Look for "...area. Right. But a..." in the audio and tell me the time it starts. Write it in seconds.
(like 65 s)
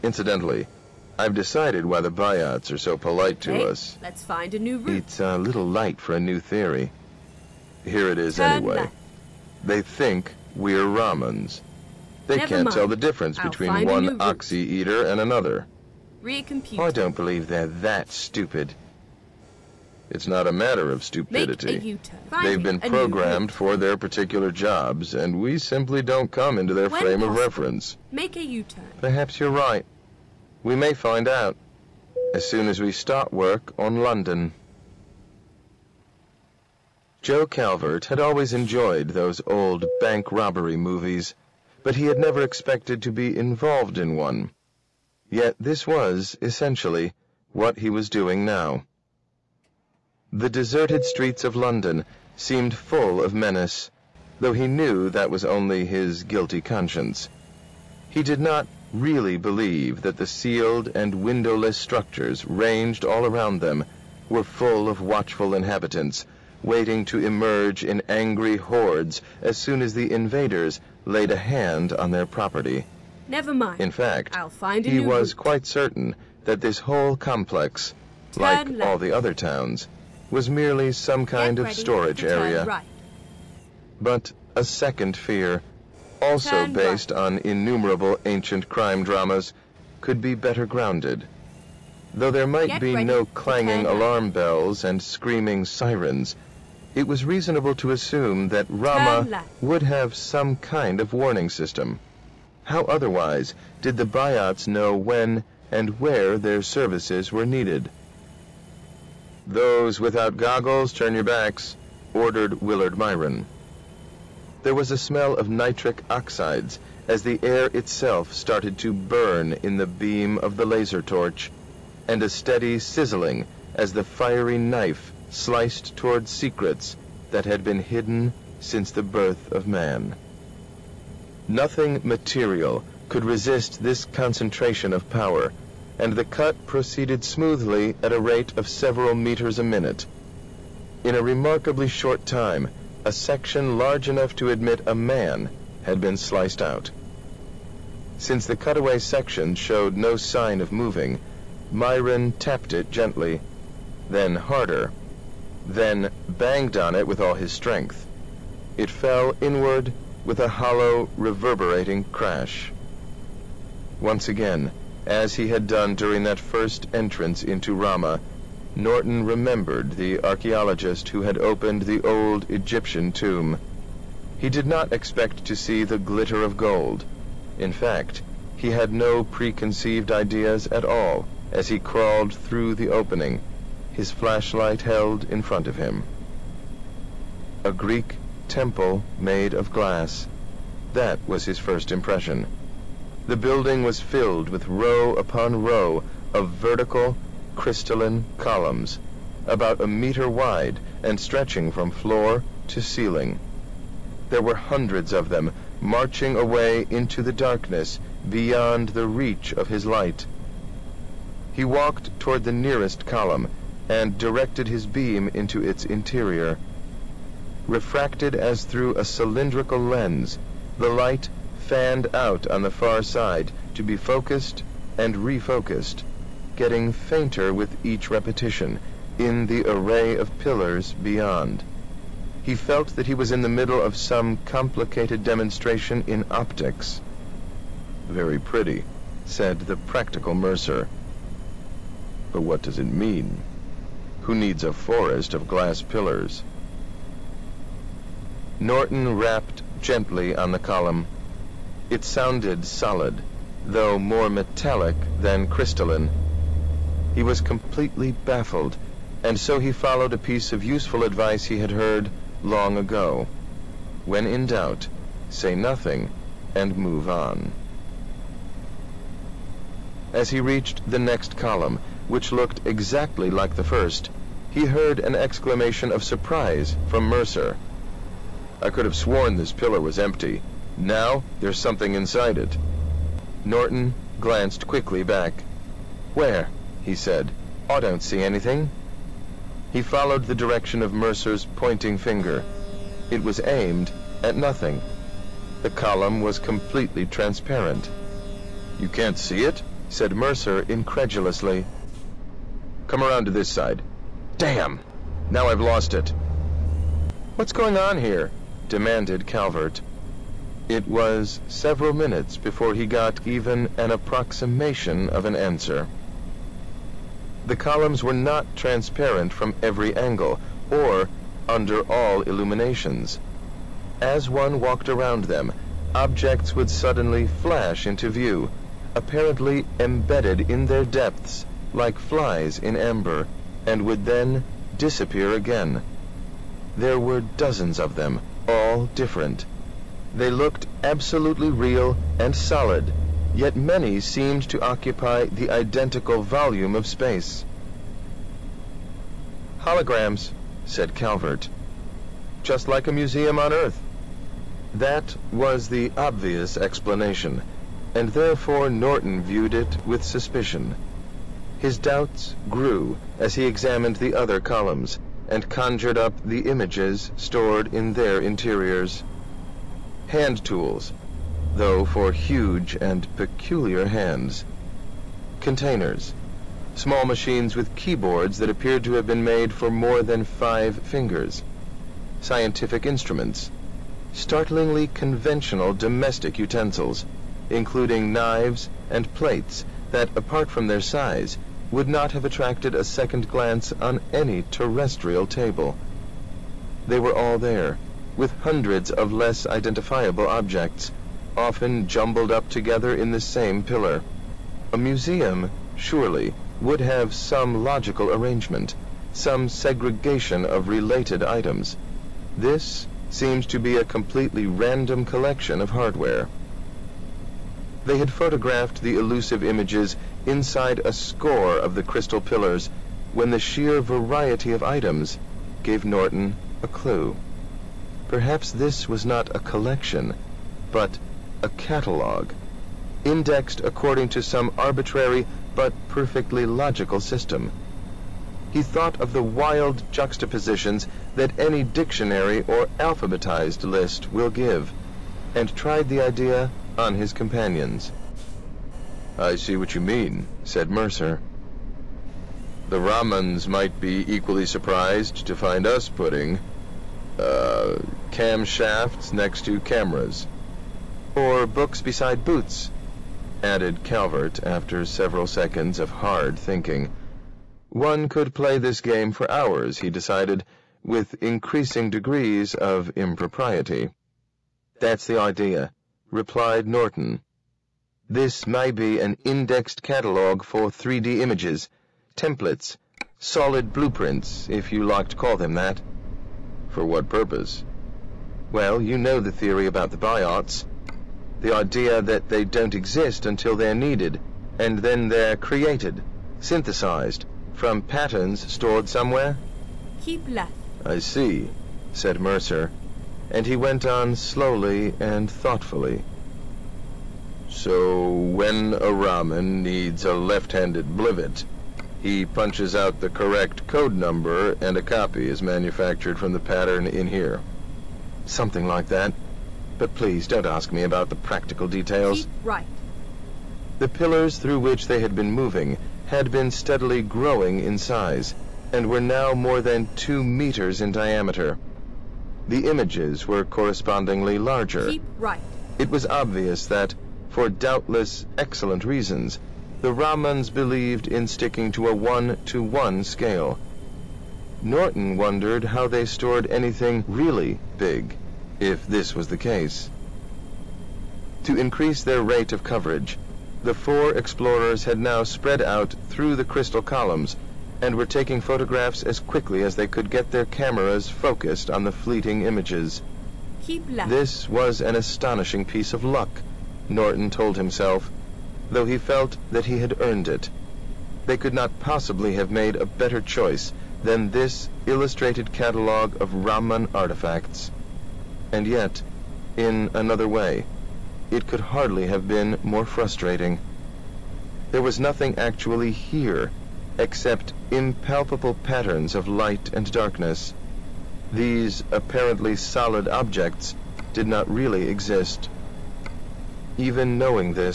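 82 s.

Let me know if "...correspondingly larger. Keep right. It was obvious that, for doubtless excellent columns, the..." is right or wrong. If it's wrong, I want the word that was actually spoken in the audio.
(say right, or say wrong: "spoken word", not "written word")
wrong: "reasons", not "columns".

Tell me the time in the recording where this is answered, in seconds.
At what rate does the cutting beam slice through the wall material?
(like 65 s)
138 s.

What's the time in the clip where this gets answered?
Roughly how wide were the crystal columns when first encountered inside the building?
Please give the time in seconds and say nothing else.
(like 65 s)
199 s.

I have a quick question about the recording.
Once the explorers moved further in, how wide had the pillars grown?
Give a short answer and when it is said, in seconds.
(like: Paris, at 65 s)
2 meters, at 529 s.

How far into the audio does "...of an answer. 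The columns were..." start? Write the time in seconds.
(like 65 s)
315 s.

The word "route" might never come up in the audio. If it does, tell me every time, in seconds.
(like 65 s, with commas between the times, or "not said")
4 s, 75 s.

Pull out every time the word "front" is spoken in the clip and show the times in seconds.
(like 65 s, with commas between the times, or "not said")
185 s.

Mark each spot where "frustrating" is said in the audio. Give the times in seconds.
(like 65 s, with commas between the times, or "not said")
582 s.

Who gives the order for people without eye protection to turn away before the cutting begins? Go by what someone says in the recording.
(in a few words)
Willard Myron.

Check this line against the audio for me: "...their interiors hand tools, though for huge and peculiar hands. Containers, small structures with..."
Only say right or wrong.
wrong.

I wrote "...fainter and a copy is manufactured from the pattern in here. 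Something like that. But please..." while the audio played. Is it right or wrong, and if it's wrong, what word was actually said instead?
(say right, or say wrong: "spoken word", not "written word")
wrong: "number", not "fainter".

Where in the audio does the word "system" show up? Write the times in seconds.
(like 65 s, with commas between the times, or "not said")
101 s, 436 s.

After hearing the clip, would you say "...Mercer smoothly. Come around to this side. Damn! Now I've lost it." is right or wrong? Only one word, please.
wrong.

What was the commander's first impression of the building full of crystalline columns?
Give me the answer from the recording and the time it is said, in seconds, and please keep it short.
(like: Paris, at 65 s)
A Greek temple made of glass, at 187 s.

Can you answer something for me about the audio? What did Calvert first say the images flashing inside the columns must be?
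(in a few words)
Holograms.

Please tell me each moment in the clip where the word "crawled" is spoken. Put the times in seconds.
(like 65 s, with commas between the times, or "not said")
181 s.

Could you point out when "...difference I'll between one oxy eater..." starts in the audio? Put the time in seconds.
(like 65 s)
12 s.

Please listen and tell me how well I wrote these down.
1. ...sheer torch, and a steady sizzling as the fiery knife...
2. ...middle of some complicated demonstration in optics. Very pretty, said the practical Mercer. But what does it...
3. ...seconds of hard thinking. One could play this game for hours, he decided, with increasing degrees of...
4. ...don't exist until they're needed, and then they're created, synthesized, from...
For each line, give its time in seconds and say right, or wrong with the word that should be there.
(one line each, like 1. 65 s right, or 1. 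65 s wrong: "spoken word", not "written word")
1. 120 s wrong: "laser", not "sheer"
2. 233 s right
3. 465 s right
4. 492 s right.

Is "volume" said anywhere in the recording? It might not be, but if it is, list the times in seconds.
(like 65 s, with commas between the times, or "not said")
346 s.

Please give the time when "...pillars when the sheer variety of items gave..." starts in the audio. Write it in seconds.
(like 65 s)
422 s.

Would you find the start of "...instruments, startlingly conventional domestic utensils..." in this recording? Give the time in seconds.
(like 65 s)
382 s.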